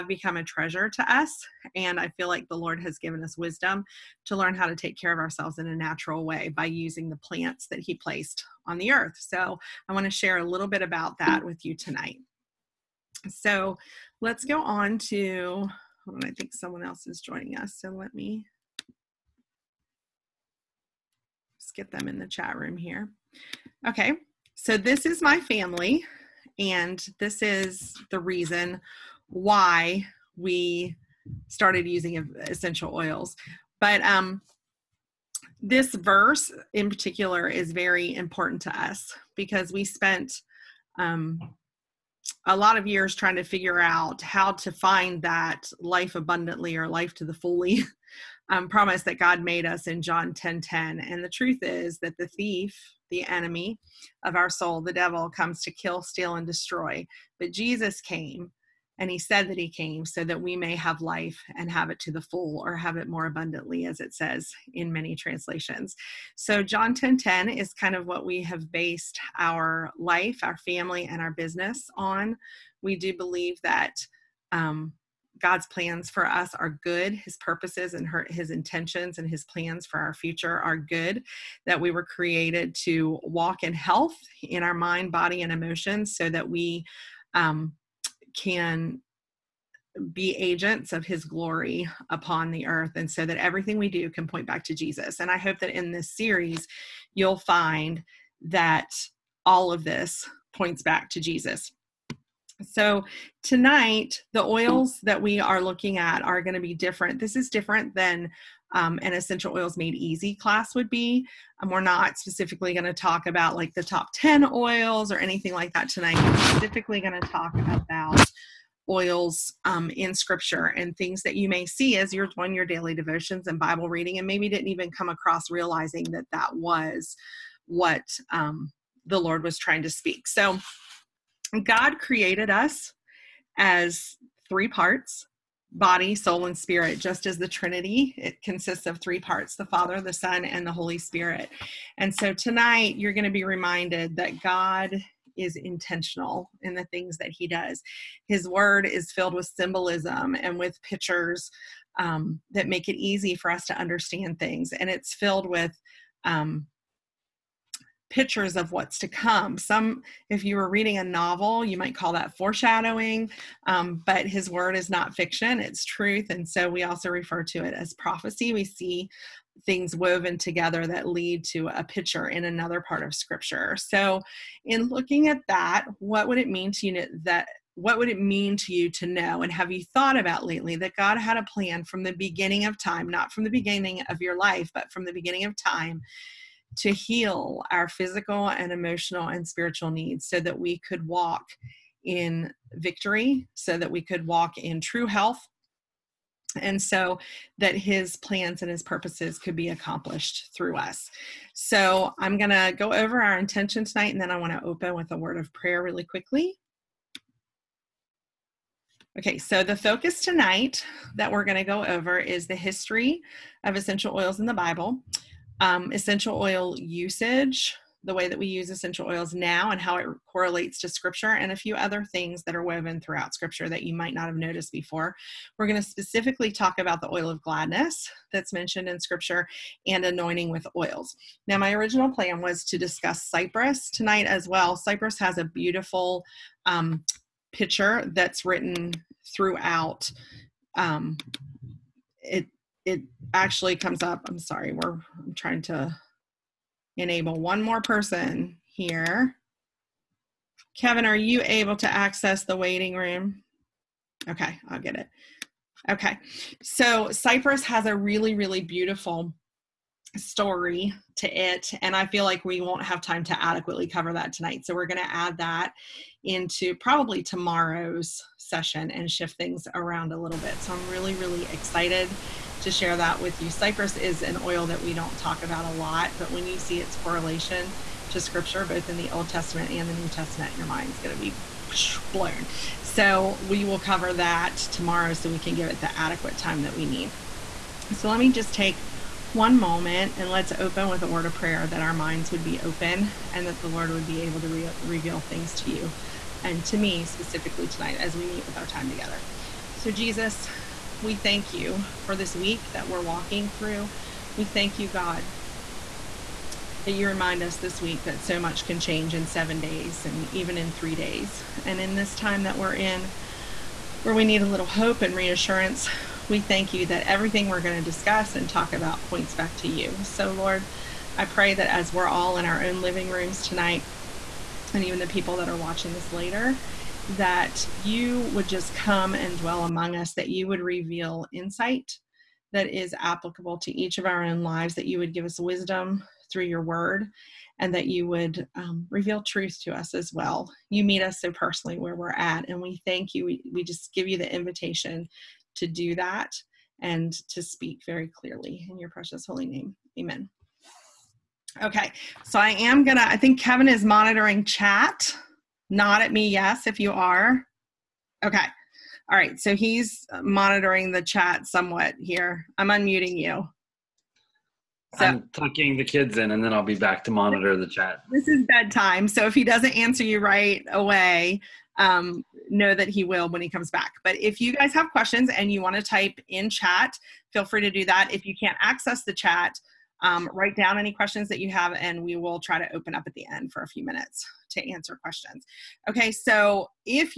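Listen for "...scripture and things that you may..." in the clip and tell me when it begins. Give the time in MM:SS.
02:00.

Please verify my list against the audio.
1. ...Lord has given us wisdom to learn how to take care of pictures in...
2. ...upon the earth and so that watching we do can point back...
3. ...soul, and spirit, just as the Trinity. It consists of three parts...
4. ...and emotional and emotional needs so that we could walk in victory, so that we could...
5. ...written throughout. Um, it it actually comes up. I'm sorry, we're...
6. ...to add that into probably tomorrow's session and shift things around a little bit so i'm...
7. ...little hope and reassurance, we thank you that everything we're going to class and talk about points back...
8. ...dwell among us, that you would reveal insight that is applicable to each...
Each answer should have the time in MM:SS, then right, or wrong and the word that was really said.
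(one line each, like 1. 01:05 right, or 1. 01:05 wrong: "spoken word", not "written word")
1. 00:02 wrong: "ourselves", not "pictures"
2. 01:32 wrong: "everything", not "watching"
3. 02:16 right
4. 03:08 wrong: "spiritual", not "emotional"
5. 03:58 right
6. 04:25 right
7. 05:14 wrong: "discuss", not "class"
8. 05:29 right.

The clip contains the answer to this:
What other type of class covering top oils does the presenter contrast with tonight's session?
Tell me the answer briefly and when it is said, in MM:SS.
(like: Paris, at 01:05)
essential oils made easy, at 01:49.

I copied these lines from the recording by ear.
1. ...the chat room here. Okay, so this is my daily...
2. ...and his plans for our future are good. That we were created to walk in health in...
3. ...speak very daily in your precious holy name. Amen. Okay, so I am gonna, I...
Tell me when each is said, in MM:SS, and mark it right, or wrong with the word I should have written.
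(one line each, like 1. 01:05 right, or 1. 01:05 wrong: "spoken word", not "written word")
1. 00:22 wrong: "family", not "daily"
2. 01:19 right
3. 05:47 wrong: "clearly", not "daily".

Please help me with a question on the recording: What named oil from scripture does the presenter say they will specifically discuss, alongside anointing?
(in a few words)
oil of gladness.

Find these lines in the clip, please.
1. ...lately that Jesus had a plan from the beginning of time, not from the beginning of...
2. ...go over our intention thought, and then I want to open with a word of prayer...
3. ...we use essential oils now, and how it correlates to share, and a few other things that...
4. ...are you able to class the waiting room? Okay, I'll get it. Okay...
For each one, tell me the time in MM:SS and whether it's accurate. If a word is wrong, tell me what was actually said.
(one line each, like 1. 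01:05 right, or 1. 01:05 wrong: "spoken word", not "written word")
1. 03:00 wrong: "God", not "Jesus"
2. 03:22 wrong: "tonight", not "thought"
3. 03:38 wrong: "scripture", not "share"
4. 04:11 wrong: "access", not "class".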